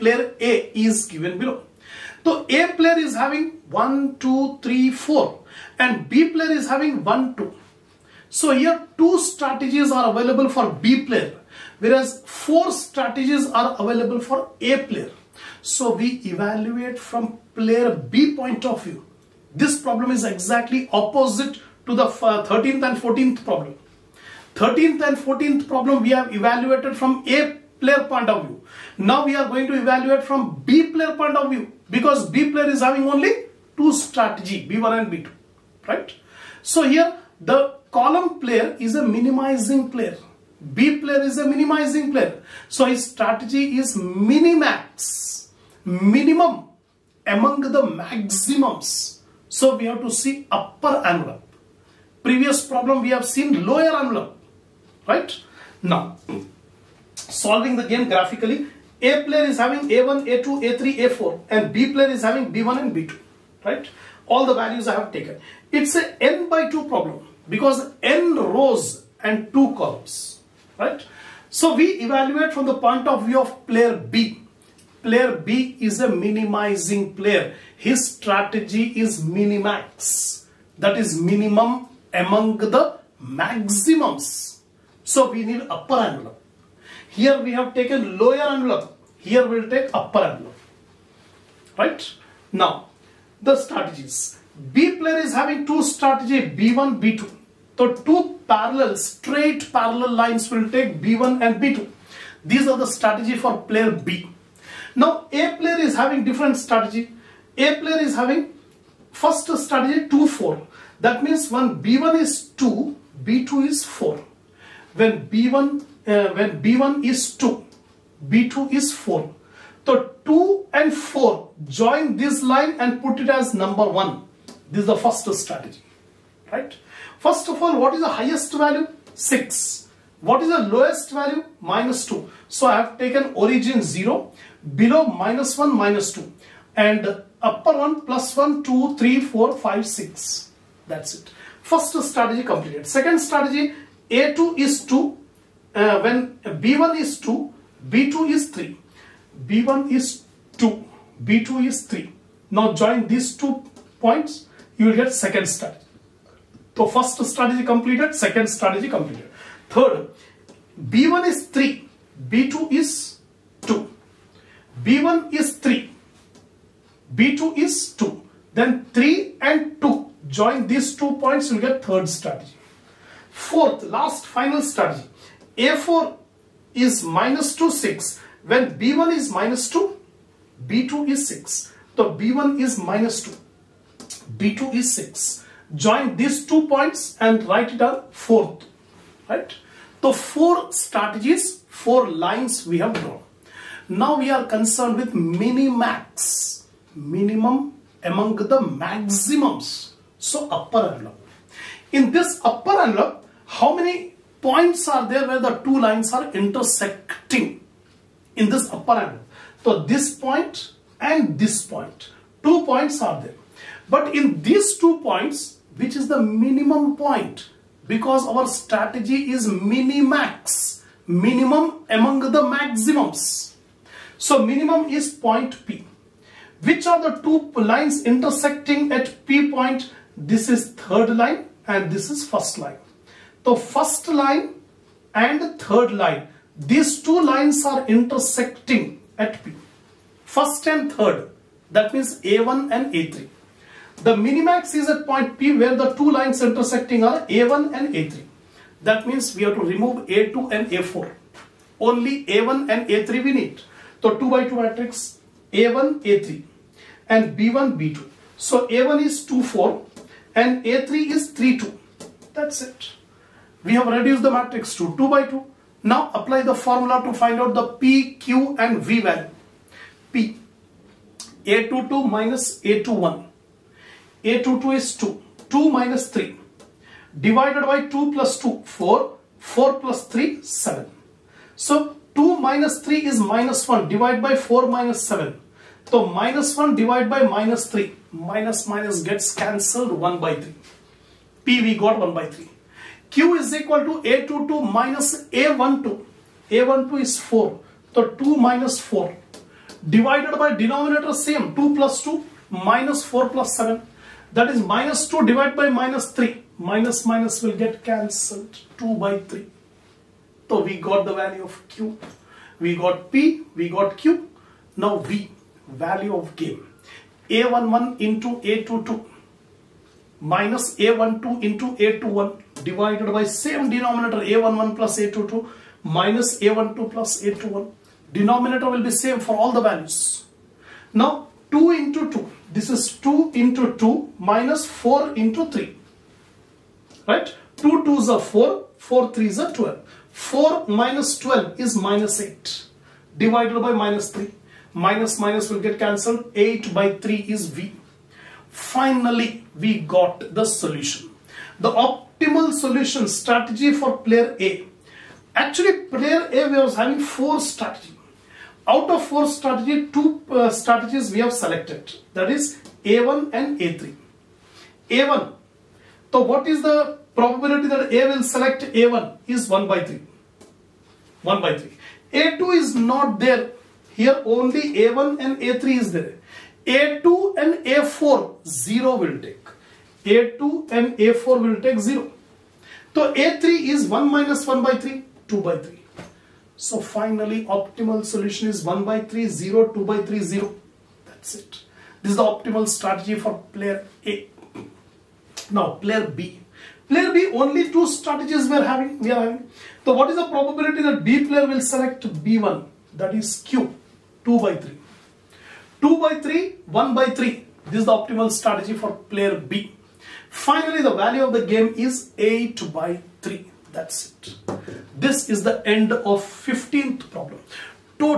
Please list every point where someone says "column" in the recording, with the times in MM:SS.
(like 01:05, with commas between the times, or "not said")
00:37, 01:09.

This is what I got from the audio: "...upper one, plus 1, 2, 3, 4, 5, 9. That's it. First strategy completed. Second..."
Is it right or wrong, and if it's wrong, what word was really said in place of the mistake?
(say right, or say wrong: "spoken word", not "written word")
wrong: "6", not "9".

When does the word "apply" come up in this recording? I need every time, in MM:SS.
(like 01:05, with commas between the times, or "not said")
04:26.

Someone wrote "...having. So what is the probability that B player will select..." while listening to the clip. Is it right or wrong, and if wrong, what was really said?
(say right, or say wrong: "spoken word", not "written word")
right.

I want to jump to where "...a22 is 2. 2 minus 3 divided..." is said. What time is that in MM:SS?
04:34.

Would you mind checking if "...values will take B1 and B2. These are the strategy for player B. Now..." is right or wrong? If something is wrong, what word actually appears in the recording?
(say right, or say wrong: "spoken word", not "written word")
wrong: "lines", not "values".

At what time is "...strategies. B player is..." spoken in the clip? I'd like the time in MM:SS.
01:33.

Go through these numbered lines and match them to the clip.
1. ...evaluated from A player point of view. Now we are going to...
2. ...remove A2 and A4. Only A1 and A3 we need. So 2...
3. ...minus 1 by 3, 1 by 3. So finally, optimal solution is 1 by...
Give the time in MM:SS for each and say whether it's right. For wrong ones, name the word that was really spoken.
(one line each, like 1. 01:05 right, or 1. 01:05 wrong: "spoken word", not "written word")
1. 00:26 right
2. 04:09 right
3. 06:24 wrong: "2", not "1".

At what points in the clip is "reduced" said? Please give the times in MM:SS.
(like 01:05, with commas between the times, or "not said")
04:23.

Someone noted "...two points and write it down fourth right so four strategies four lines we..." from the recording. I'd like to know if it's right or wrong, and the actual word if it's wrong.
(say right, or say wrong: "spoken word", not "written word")
right.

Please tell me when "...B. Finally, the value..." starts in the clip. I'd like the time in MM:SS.
06:49.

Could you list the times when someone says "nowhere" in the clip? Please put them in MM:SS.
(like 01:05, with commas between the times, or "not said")
not said.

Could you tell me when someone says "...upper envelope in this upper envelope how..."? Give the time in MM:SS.
03:20.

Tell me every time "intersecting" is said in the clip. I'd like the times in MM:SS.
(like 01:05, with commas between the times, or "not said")
03:26, 03:48, 03:57, 04:06.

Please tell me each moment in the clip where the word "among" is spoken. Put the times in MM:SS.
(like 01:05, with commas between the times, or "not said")
00:47, 01:22, 03:18, 03:41.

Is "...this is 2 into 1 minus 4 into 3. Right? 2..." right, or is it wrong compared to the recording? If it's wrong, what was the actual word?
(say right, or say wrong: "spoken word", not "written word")
wrong: "2", not "1".